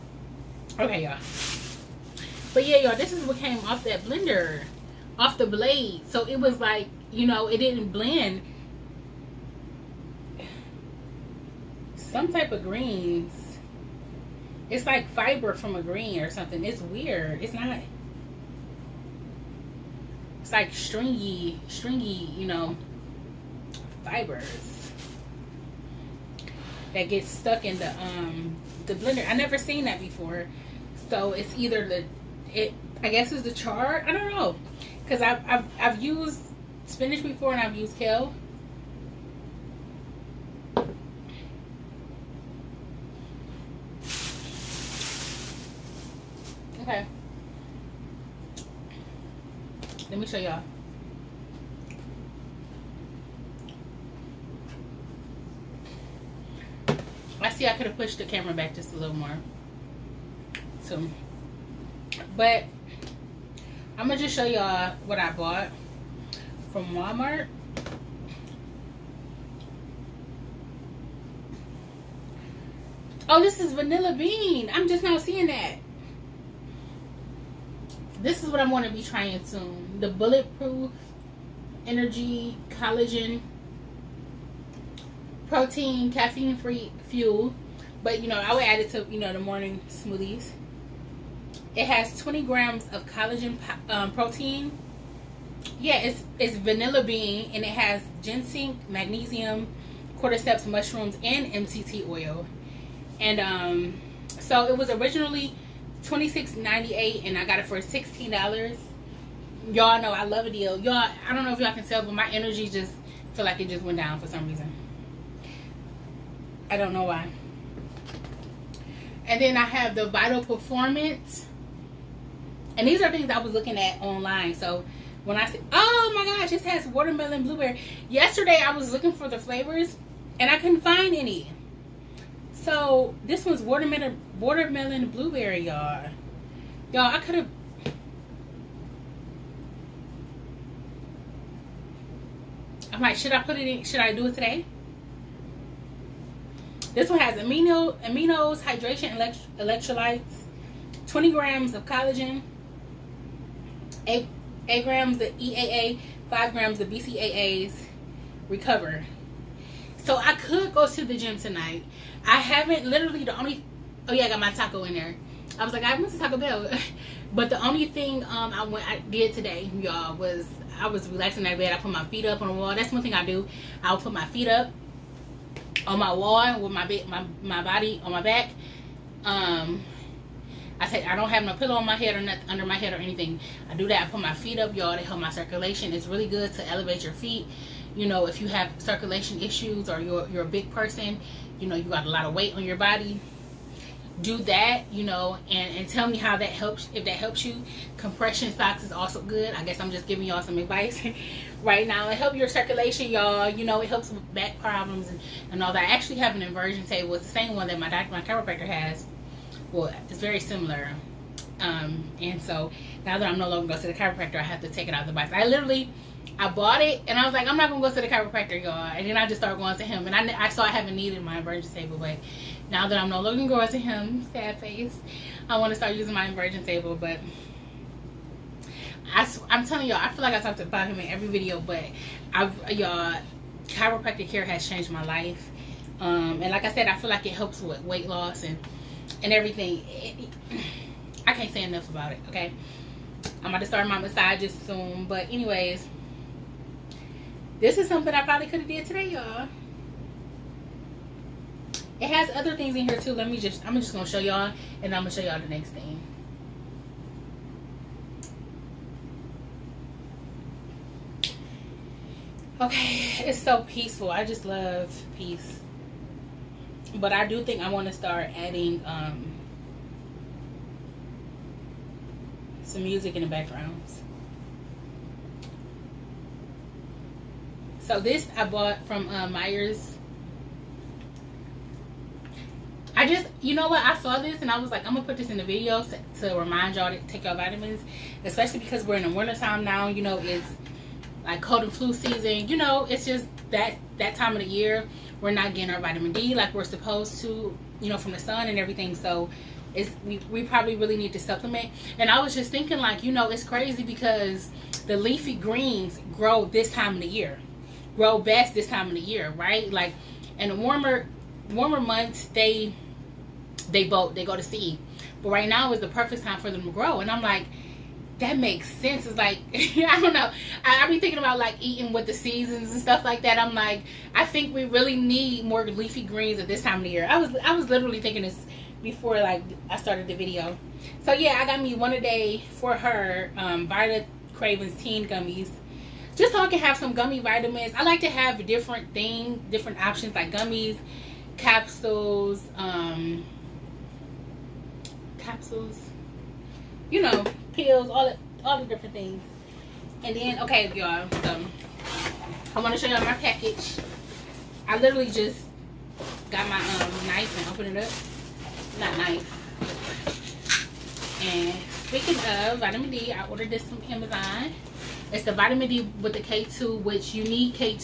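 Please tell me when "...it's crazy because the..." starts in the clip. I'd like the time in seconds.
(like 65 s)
303 s.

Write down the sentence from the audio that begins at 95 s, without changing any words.
Yeah, it's, it's vanilla bean and it has ginseng, magnesium, cordyceps mushrooms, and MCT oil.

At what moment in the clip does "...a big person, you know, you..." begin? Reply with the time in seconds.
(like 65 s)
190 s.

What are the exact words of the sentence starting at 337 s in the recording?
I like to have different things, different options like gummies, capsules, um, capsules, you know, pills, all the, all the different things.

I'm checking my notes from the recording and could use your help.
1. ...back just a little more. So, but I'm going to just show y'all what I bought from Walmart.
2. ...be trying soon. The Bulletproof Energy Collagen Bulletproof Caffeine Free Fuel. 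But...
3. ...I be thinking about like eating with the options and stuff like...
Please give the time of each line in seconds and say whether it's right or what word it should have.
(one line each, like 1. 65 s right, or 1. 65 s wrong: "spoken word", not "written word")
1. 58 s right
2. 78 s wrong: "Protein", not "Bulletproof"
3. 320 s wrong: "seasons", not "options".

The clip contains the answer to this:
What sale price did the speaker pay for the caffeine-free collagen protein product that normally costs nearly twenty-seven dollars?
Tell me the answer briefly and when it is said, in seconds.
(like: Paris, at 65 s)
$16, at 107 s.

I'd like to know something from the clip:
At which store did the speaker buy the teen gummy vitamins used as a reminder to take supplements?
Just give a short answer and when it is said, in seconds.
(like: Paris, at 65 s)
Meijer's, at 279 s.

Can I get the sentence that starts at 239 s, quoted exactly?
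It, I can't say enough about it, okay?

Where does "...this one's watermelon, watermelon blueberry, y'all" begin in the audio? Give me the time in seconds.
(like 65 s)
133 s.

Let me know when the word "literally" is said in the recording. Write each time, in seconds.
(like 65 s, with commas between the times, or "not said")
162 s, 215 s, 327 s, 354 s.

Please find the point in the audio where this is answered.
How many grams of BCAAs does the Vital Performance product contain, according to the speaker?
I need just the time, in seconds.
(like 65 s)
156 s.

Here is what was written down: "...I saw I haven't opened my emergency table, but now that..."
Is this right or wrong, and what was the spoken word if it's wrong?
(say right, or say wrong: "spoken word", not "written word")
wrong: "needed", not "opened".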